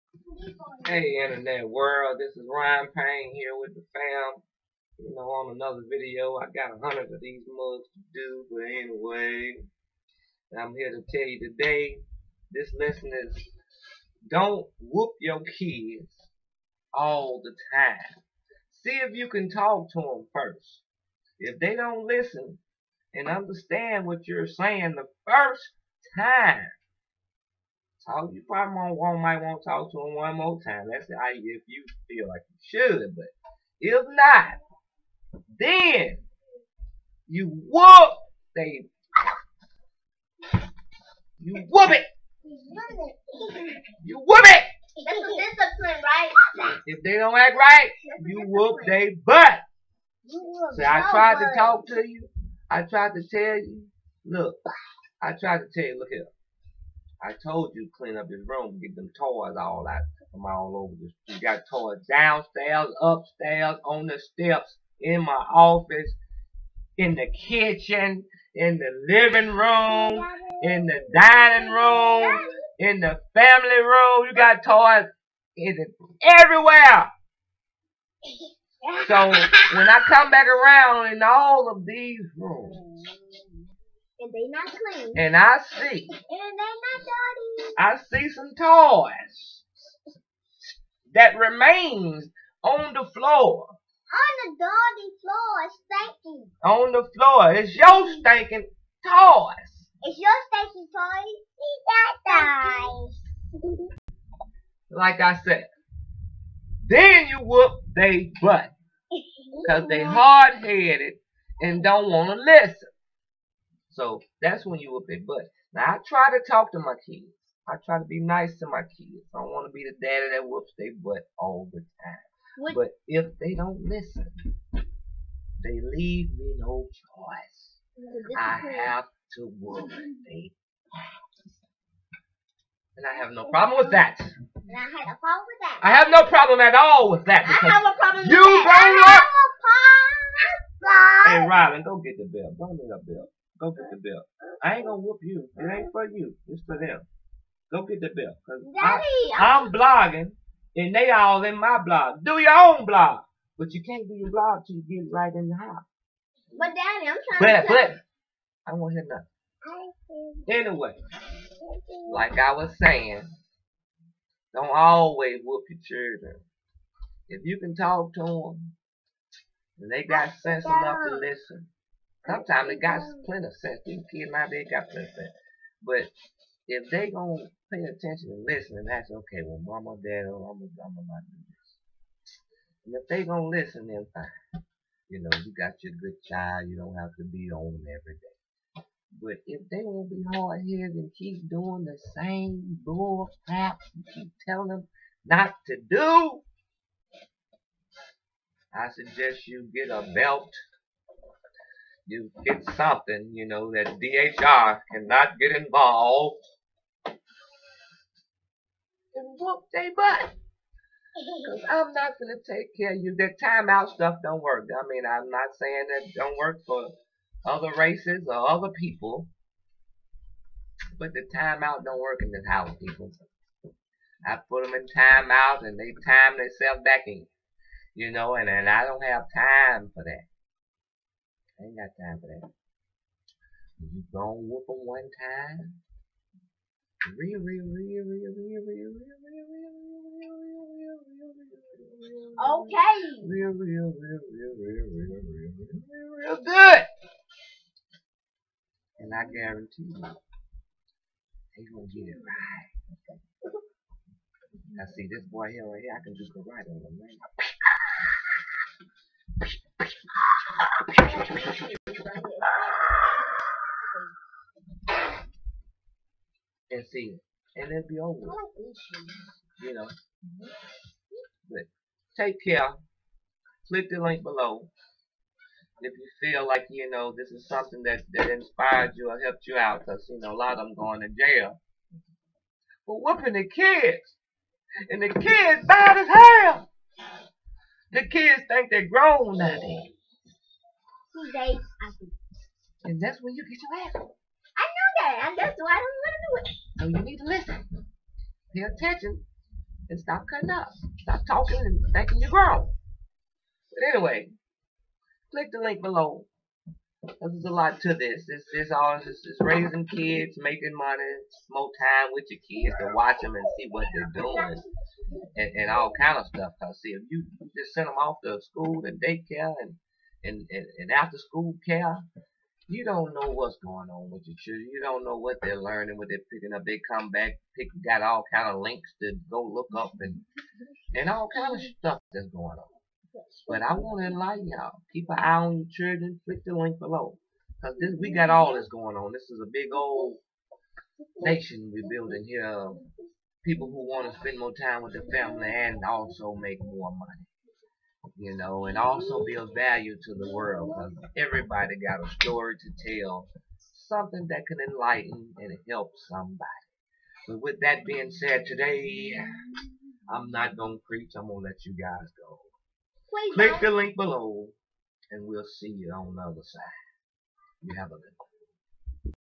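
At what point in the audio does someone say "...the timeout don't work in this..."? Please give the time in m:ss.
3:41.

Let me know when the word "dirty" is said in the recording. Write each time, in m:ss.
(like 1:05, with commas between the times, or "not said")
1:27, 1:34.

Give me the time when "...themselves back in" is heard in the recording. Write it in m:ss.
3:46.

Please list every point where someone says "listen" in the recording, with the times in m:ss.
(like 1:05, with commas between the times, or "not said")
0:22, 1:52, 2:03, 2:51, 2:58, 3:03, 4:57.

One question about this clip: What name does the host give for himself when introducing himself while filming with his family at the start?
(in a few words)
Ryan Payne.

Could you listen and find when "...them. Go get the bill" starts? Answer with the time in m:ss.
2:26.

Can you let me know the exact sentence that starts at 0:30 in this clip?
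That's how you, if you feel like you should.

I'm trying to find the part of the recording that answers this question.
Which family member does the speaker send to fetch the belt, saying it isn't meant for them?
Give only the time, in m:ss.
2:21.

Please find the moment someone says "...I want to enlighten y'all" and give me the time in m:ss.
5:33.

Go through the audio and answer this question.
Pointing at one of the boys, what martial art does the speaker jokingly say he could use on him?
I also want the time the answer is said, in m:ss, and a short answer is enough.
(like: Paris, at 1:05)
karate, at 4:16.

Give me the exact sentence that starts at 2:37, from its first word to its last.
But but I won't hit nothing.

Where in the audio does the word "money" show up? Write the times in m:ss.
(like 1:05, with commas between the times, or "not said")
5:10, 5:46.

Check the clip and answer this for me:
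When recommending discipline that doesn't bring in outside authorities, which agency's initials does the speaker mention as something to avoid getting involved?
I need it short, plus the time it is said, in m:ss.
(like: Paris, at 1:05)
DHR, at 3:24.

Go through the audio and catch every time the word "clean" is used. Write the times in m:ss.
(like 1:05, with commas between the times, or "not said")
0:57, 1:24.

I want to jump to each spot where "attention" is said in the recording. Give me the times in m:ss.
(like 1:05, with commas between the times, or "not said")
2:57, 4:58.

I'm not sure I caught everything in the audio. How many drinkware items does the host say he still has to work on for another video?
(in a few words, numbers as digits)
100.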